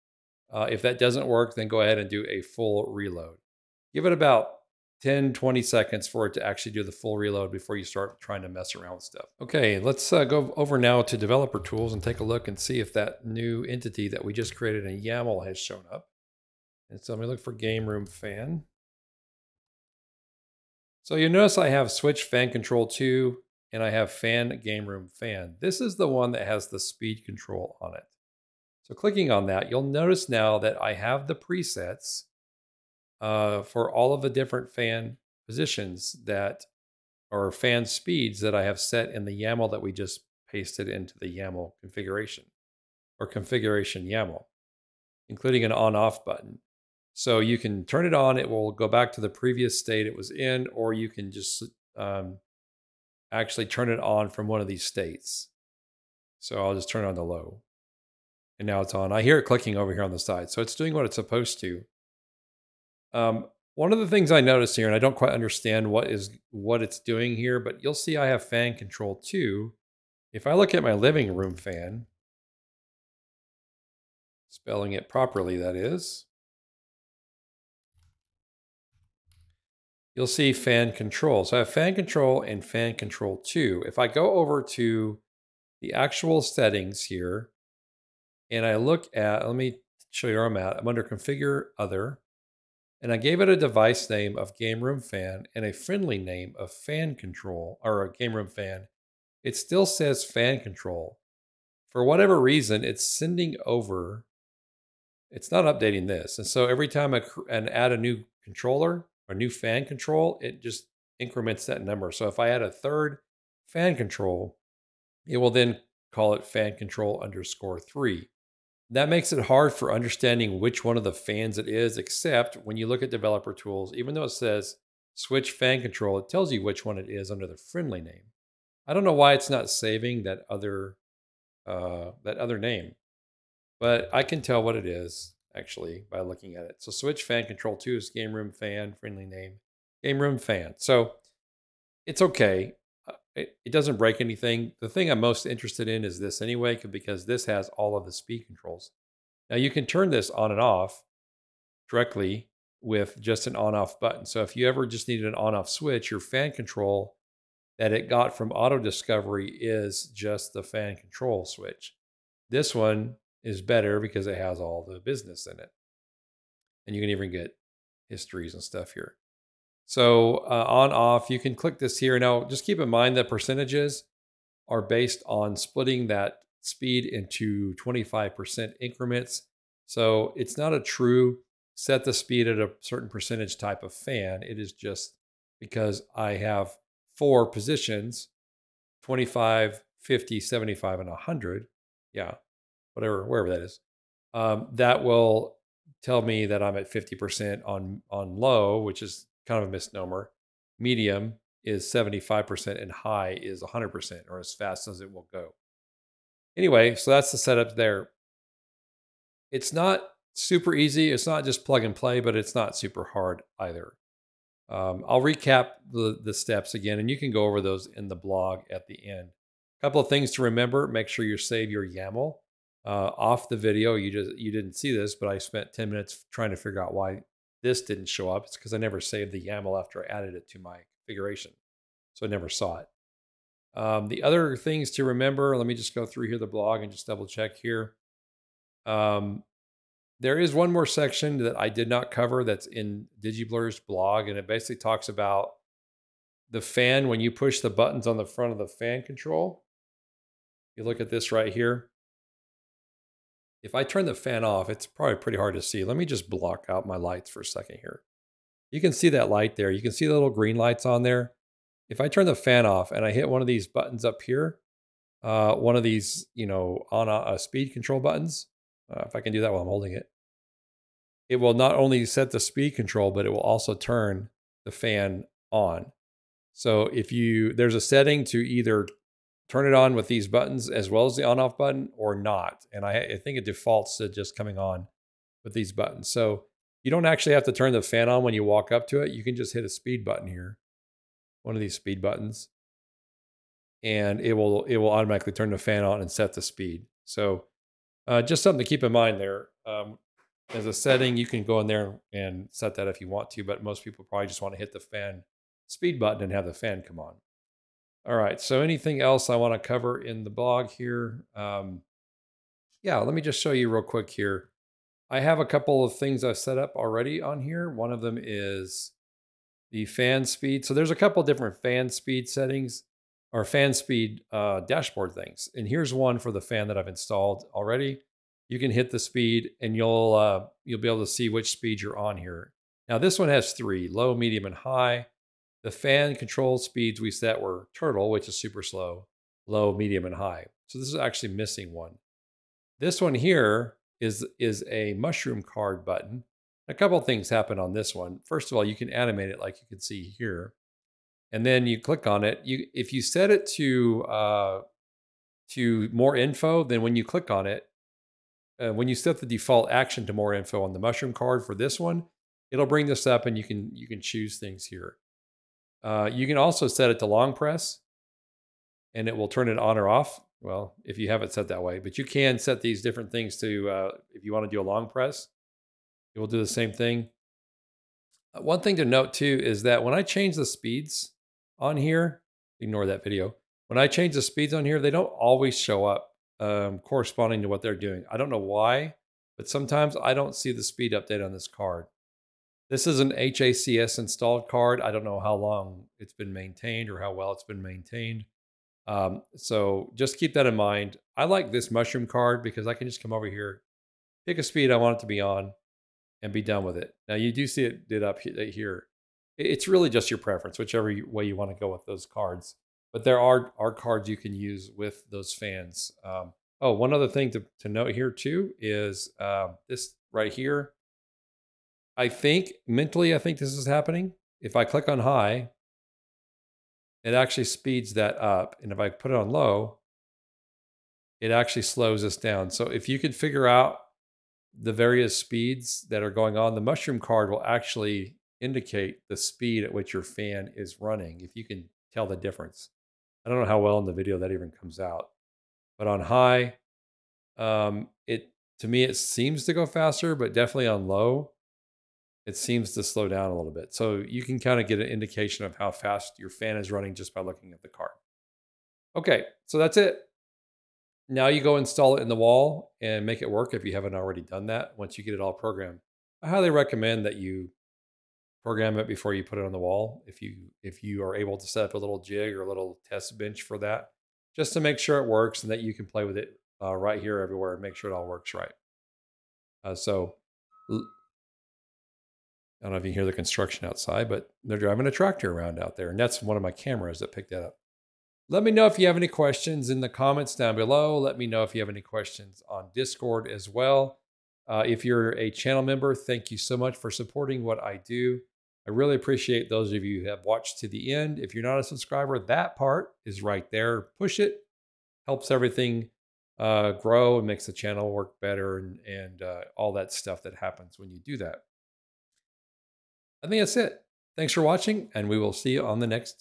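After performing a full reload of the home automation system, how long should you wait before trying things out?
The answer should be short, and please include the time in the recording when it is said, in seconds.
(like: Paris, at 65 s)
10 to 20 seconds, at 5 s.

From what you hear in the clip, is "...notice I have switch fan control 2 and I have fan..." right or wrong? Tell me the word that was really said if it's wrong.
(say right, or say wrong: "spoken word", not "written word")
right.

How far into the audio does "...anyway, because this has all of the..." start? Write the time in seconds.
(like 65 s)
146 s.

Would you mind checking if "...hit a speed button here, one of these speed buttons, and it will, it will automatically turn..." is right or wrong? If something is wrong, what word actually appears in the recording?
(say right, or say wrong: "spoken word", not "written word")
right.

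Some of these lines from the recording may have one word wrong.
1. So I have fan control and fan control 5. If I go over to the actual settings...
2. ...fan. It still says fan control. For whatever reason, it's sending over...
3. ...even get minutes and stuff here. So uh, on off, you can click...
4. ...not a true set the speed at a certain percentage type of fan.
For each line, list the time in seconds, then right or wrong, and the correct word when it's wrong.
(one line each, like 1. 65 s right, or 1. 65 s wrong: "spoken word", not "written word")
1. 81 s wrong: "2", not "5"
2. 98 s right
3. 167 s wrong: "histories", not "minutes"
4. 180 s right.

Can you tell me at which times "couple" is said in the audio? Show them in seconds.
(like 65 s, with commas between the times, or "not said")
219 s, 315 s, 320 s, 346 s.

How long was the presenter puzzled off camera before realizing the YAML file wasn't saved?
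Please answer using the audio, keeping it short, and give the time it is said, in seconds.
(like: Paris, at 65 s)
10 minutes, at 225 s.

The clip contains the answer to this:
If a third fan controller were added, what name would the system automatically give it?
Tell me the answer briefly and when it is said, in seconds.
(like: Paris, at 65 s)
fan control_3, at 116 s.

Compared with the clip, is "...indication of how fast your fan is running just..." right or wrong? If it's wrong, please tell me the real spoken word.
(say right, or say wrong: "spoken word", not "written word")
right.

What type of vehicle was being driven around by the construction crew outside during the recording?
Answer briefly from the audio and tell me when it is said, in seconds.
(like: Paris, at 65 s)
A tractor, at 484 s.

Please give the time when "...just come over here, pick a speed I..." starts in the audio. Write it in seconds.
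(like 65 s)
402 s.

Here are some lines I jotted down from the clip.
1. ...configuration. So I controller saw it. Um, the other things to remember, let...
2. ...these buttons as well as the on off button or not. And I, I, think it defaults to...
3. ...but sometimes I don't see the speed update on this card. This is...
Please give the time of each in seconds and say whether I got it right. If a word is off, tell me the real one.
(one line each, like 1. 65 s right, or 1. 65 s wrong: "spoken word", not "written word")
1. 230 s wrong: "never", not "controller"
2. 280 s right
3. 389 s right.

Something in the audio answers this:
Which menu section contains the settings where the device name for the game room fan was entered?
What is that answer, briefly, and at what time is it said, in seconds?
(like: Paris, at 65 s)
Configure other, at 91 s.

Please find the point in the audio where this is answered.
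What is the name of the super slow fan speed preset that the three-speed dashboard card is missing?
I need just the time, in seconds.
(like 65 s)
337 s.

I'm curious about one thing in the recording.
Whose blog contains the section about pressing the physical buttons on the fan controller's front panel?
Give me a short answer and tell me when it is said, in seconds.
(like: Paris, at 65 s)
DigiBlur, at 243 s.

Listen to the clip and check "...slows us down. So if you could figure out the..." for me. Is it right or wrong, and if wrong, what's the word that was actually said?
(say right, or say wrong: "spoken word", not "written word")
right.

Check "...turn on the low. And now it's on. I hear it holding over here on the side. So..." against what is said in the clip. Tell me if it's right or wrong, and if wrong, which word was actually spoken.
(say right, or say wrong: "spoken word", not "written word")
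wrong: "clicking", not "holding".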